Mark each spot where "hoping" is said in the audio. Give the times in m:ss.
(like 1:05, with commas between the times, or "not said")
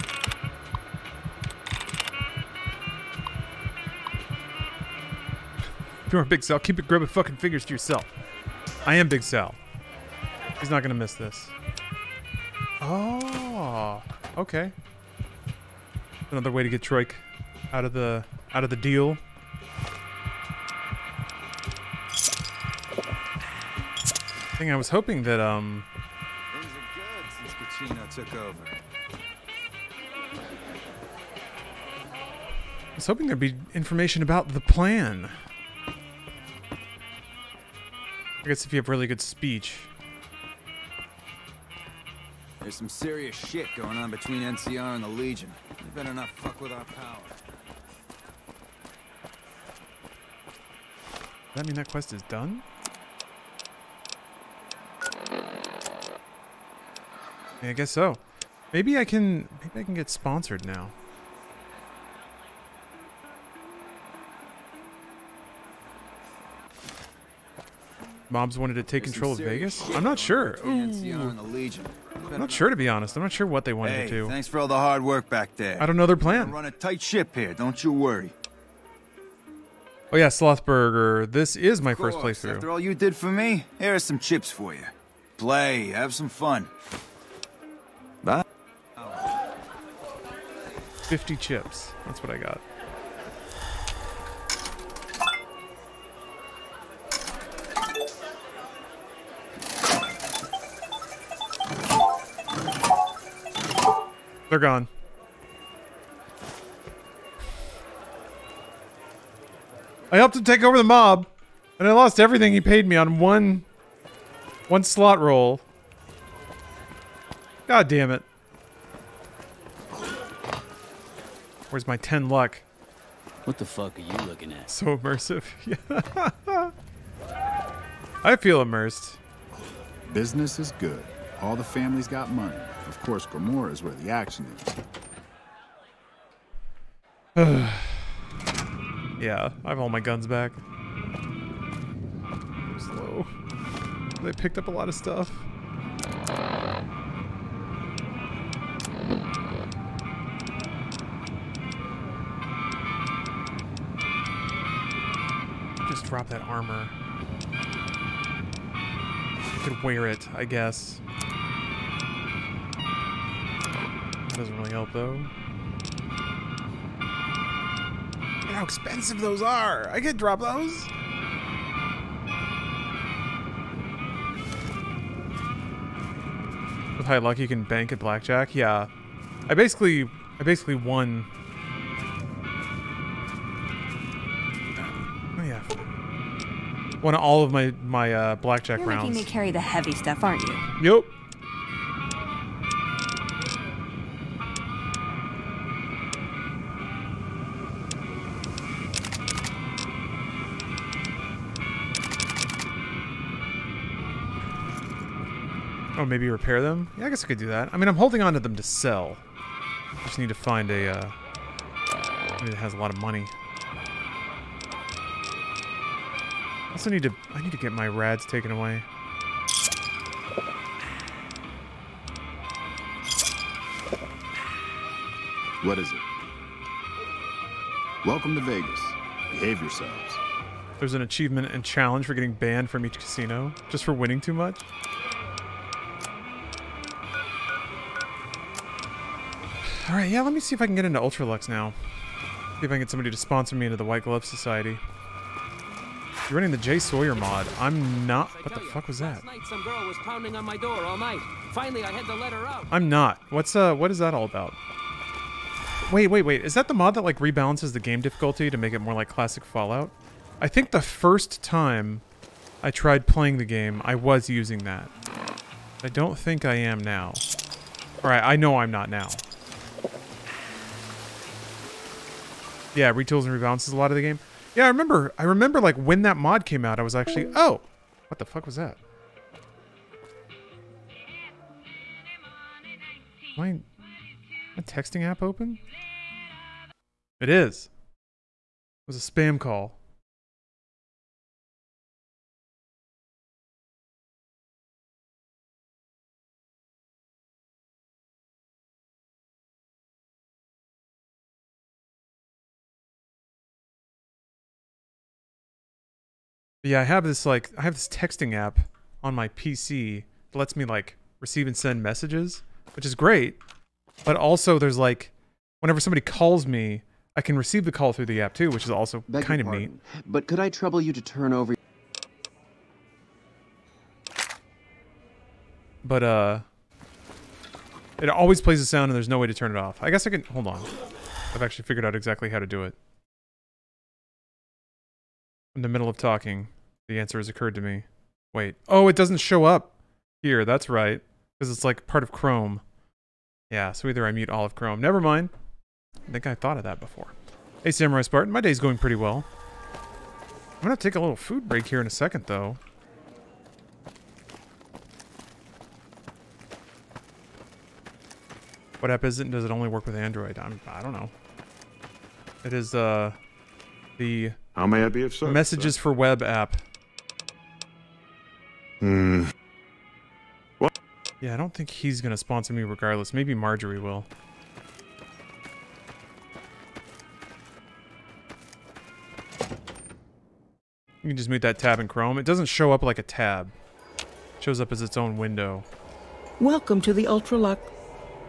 0:24, 0:33.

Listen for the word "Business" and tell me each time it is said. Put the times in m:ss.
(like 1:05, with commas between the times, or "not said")
2:10.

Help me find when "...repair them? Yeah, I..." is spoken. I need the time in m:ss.
3:26.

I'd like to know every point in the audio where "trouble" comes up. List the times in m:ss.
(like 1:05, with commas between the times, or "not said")
5:20.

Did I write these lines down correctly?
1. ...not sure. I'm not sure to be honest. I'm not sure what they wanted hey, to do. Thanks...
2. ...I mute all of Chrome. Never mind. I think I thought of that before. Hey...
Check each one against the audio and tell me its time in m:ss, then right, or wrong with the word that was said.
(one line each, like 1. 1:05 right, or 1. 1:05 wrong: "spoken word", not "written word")
1. 1:10 right
2. 5:44 right.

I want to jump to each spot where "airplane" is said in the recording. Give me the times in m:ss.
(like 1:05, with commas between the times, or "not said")
not said.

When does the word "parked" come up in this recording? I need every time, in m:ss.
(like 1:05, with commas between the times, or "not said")
not said.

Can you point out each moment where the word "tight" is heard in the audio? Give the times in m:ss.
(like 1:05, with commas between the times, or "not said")
1:16.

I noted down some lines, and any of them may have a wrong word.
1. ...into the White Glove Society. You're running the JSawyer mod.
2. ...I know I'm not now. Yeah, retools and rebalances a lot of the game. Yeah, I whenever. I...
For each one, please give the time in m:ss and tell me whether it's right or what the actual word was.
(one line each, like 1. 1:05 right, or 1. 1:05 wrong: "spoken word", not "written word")
1. 4:03 right
2. 4:28 wrong: "remember", not "whenever".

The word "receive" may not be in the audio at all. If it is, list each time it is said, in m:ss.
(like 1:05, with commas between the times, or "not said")
5:11, 5:17.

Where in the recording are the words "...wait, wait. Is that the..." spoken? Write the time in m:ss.
4:16.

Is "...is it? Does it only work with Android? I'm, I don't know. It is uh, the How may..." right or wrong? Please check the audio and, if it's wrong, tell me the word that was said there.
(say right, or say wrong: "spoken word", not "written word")
right.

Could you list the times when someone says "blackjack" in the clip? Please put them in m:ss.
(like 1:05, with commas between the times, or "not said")
2:57, 3:08.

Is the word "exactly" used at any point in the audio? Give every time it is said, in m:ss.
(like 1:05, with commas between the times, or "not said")
5:31.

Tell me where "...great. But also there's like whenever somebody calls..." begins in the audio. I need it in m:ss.
5:12.